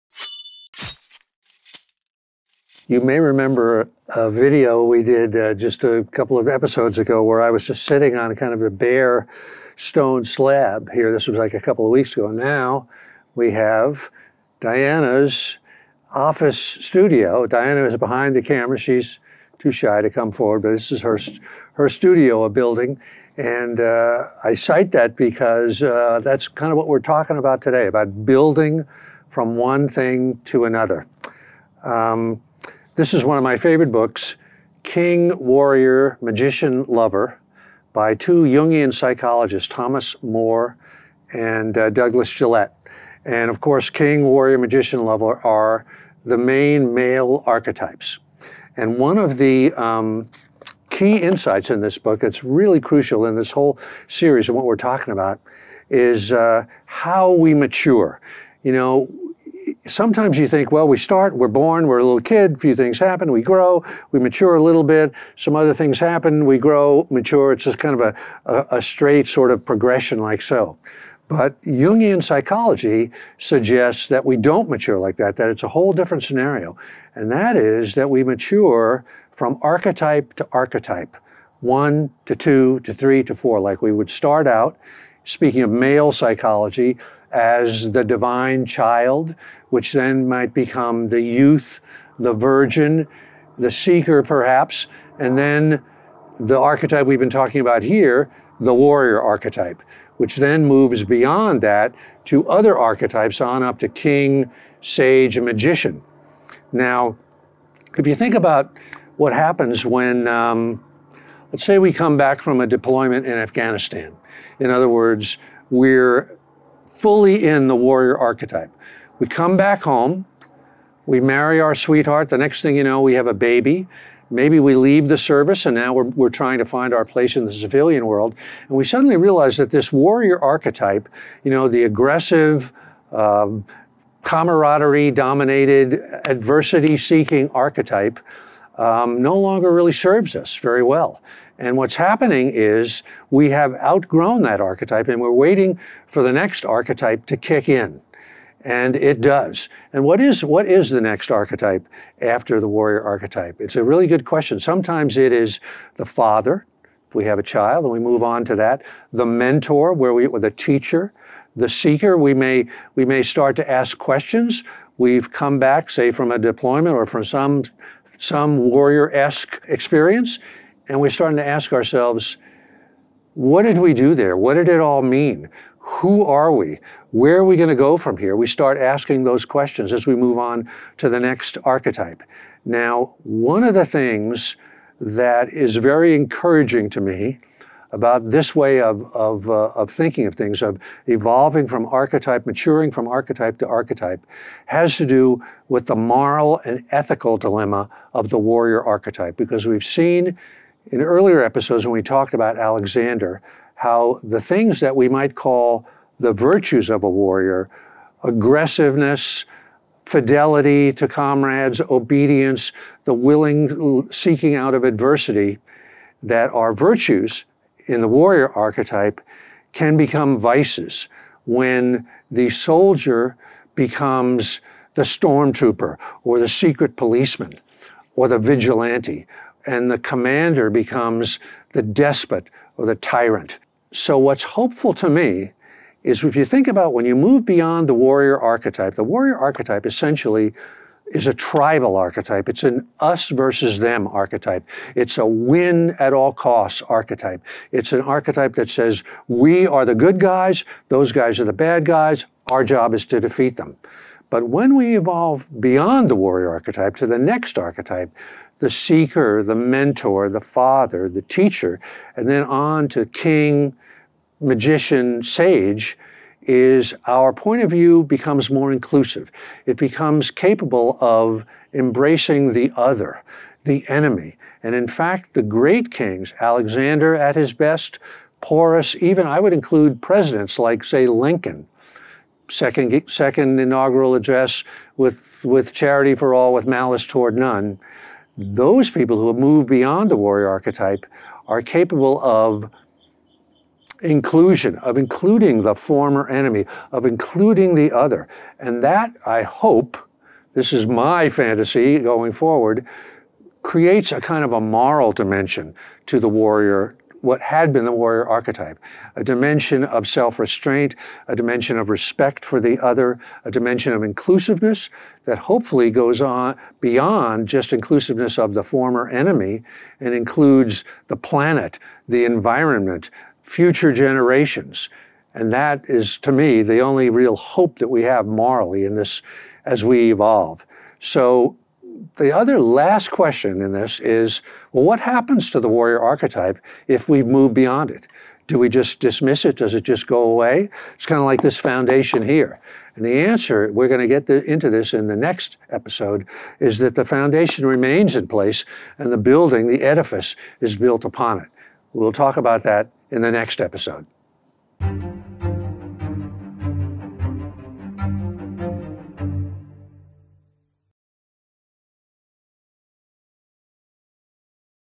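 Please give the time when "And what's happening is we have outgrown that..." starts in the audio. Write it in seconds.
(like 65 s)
141 s.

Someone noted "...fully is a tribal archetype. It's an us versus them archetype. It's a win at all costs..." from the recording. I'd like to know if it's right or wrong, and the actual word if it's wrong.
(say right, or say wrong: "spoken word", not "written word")
wrong: "essentially", not "fully".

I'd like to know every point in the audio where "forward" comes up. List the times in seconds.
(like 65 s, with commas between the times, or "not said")
20 s, 302 s.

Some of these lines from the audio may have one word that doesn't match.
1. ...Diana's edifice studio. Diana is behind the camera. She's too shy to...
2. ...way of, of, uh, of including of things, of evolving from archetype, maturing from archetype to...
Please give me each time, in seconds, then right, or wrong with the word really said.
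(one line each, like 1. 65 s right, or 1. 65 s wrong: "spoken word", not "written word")
1. 14 s wrong: "office", not "edifice"
2. 188 s wrong: "thinking", not "including".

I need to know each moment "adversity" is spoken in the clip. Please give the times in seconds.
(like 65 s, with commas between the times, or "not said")
136 s, 214 s.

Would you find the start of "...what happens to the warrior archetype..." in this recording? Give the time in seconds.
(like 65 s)
334 s.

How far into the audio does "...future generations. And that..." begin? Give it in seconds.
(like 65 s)
323 s.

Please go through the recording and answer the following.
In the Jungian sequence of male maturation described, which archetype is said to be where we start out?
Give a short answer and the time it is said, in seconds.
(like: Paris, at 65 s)
divine child, at 88 s.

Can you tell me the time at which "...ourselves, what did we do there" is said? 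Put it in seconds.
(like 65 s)
171 s.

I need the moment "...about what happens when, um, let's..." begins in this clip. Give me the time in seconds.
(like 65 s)
108 s.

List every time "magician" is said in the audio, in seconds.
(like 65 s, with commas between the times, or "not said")
36 s, 44 s, 105 s, 264 s.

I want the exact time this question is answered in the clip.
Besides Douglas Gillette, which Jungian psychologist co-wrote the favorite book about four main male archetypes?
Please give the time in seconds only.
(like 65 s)
39 s.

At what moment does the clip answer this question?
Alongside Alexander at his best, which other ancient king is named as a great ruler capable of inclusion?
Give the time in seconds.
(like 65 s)
278 s.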